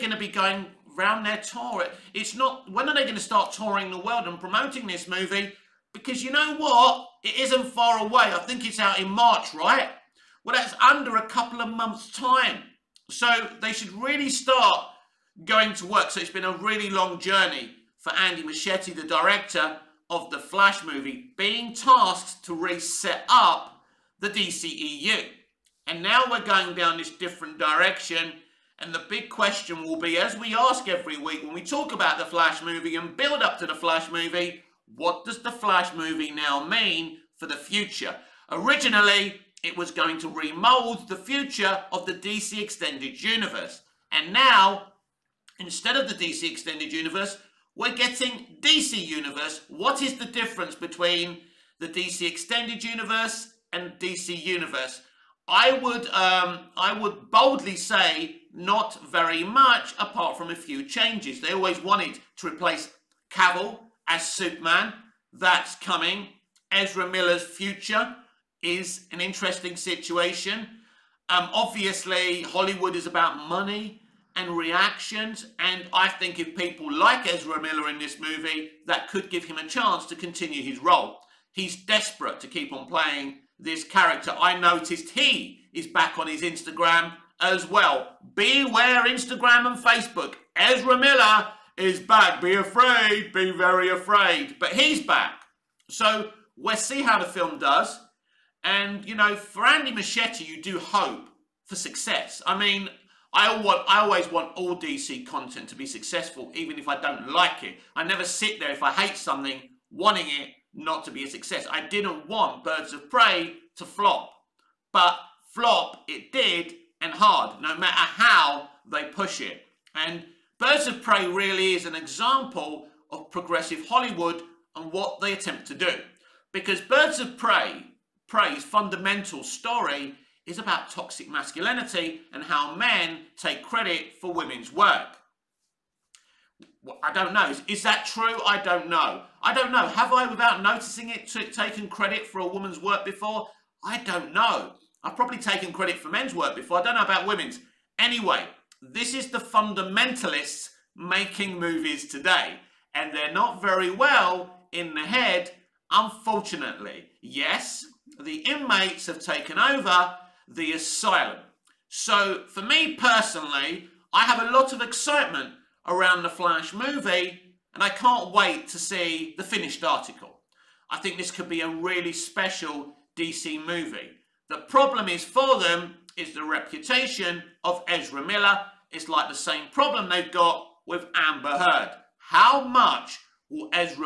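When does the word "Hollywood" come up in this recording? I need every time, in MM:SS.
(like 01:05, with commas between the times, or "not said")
01:12, 02:03.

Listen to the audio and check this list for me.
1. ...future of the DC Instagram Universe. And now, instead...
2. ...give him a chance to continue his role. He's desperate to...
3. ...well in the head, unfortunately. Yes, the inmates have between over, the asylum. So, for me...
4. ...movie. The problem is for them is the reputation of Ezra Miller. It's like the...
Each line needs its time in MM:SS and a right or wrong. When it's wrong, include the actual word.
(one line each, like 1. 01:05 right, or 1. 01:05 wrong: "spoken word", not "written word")
1. 00:41 wrong: "Extended", not "Instagram"
2. 01:19 right
3. 02:33 wrong: "taken", not "between"
4. 02:53 right.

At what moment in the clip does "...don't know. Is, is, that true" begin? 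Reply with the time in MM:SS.
02:17.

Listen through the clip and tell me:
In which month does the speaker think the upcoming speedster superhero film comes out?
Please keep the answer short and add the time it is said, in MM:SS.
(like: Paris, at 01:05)
March, at 00:09.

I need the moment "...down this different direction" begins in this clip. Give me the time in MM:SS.
00:26.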